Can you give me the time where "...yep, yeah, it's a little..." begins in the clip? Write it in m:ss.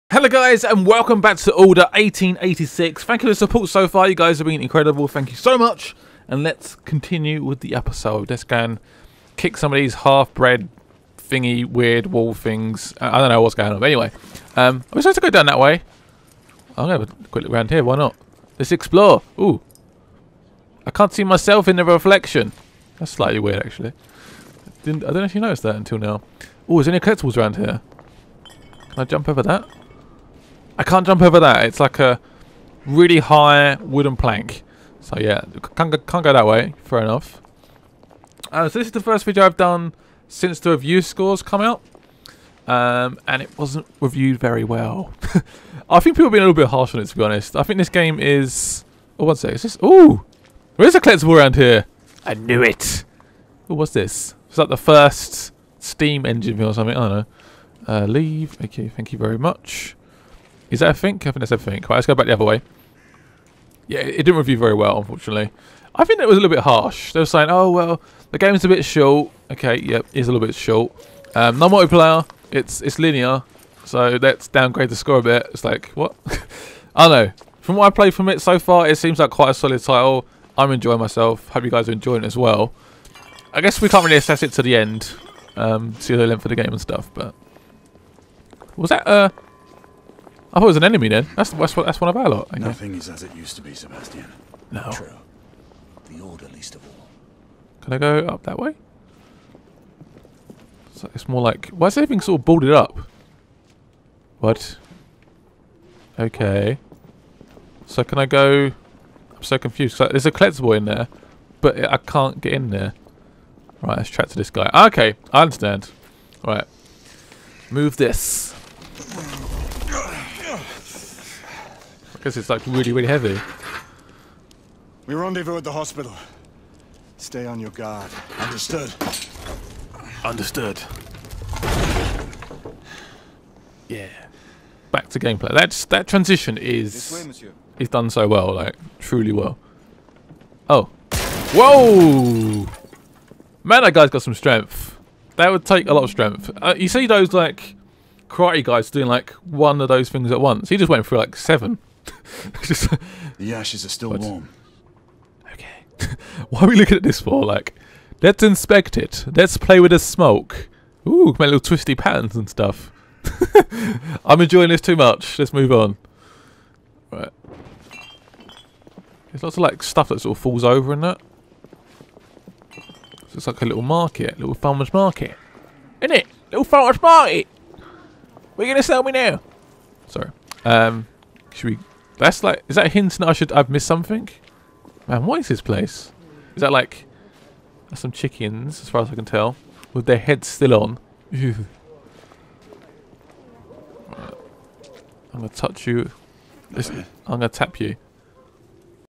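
1:09.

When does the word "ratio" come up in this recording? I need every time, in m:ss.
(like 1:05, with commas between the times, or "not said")
not said.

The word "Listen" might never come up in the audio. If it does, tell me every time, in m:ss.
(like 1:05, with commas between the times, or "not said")
3:16.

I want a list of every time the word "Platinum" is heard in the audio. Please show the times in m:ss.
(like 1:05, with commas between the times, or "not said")
not said.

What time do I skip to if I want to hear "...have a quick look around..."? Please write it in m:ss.
0:17.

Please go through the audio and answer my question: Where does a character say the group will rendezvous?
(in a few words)
the hospital.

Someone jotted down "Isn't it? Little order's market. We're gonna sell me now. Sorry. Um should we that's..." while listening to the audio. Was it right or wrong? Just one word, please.
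wrong.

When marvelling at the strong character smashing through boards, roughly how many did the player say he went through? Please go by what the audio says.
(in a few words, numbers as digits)
7.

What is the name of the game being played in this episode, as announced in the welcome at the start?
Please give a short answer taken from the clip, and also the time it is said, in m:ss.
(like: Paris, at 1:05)
Order 1886, at 0:01.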